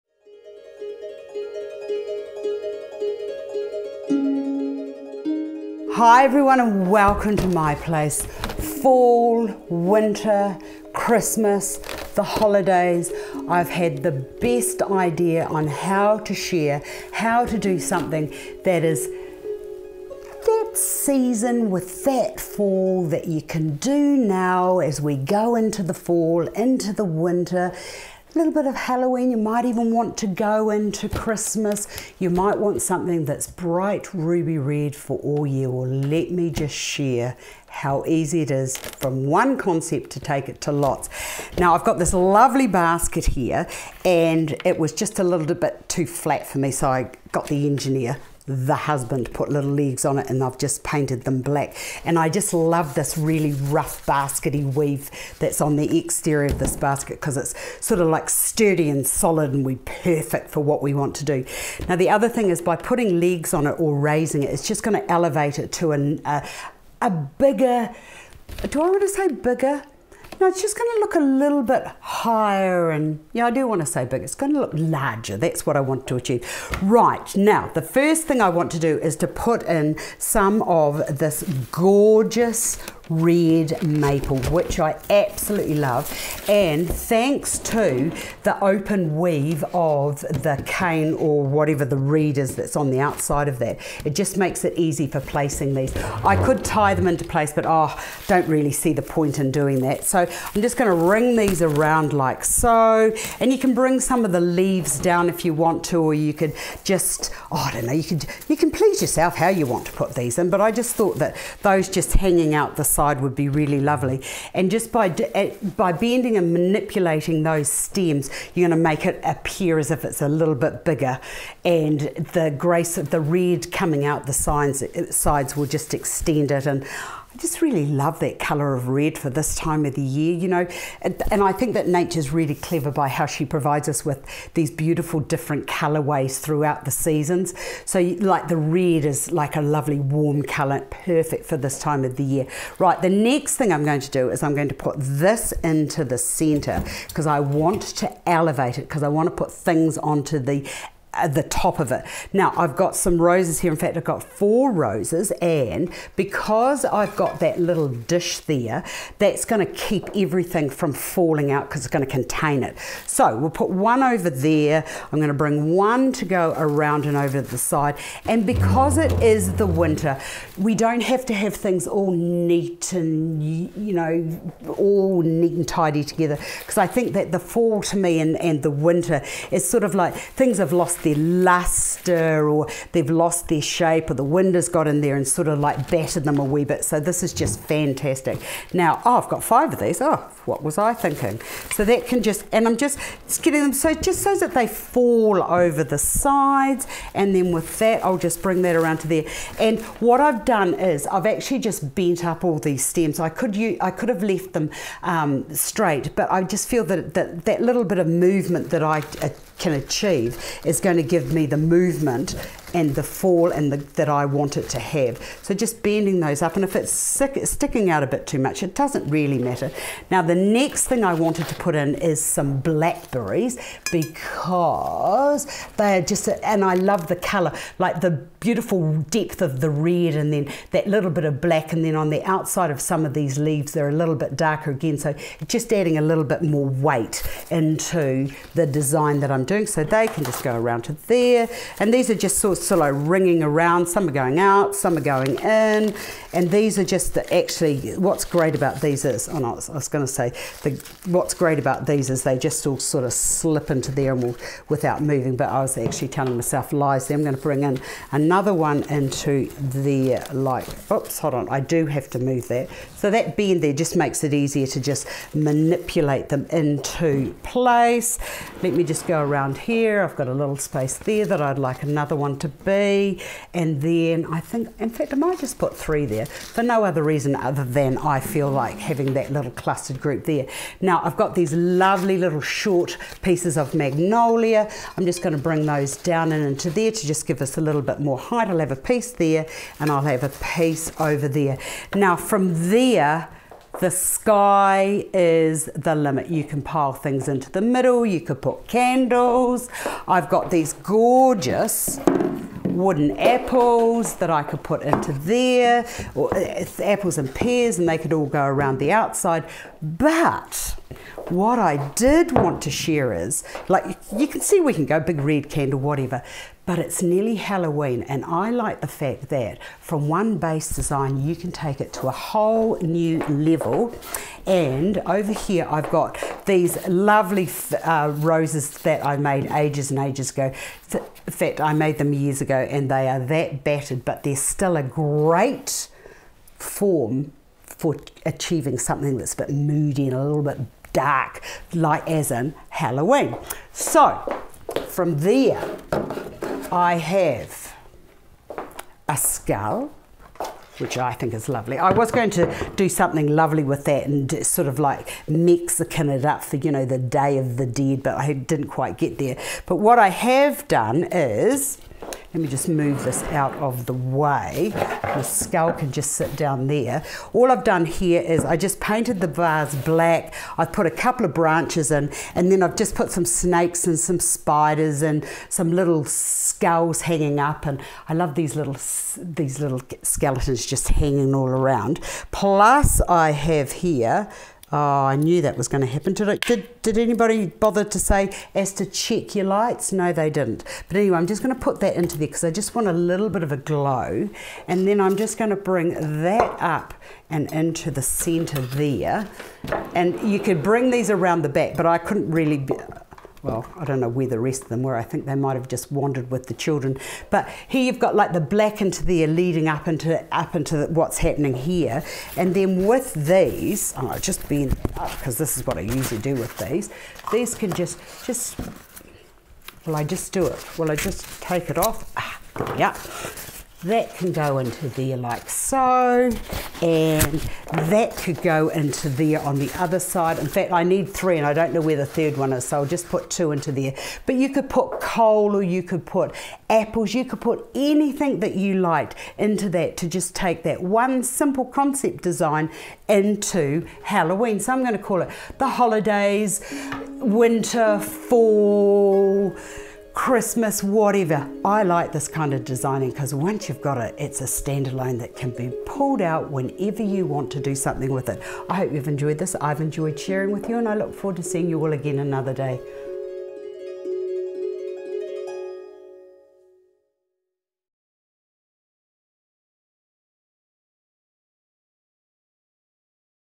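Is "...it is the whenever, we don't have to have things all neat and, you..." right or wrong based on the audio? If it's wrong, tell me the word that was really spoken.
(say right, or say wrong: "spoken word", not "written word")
wrong: "winter", not "whenever".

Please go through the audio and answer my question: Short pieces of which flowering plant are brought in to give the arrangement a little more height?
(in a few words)
Magnolia.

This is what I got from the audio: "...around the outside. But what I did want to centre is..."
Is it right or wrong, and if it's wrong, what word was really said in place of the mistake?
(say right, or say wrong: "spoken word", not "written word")
wrong: "share", not "centre".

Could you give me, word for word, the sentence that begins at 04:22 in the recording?
So that bend there just makes it easier to just manipulate them into place.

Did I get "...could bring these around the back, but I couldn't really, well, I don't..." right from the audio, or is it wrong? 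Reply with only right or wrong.
right.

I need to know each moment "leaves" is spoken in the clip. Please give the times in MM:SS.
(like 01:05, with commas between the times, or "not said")
01:44, 03:53.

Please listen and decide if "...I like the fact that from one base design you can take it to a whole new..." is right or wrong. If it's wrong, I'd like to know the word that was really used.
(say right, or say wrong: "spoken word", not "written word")
right.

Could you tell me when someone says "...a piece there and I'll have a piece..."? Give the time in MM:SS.
04:48.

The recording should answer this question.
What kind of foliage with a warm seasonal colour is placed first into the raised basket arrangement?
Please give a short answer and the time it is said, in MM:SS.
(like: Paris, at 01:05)
Red maple, at 01:23.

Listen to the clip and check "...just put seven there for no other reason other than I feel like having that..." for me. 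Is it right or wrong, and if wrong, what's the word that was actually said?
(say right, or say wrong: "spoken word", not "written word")
wrong: "three", not "seven".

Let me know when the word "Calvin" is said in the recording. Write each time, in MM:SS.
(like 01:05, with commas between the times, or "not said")
not said.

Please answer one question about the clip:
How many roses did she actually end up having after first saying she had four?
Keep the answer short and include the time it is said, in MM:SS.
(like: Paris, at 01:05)
5, at 03:09.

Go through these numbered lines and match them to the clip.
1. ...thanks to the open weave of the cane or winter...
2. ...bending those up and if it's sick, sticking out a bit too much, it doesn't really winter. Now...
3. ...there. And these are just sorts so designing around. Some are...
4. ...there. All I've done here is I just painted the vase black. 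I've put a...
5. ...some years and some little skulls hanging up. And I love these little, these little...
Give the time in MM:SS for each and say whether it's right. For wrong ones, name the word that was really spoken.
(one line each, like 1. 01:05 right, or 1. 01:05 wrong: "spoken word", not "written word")
1. 01:26 wrong: "whatever", not "winter"
2. 03:35 wrong: "matter", not "winter"
3. 04:01 wrong: "ringing", not "designing"
4. 06:06 right
5. 06:13 wrong: "spiders", not "years".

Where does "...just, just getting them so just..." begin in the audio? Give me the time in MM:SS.
03:12.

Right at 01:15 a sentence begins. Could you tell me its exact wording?
That's what I want to achieve.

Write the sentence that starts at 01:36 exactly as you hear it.
I could tie them into place, but oh, don't really see the point in doing that.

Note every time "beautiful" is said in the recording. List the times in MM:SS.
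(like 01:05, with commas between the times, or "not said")
02:14, 03:48.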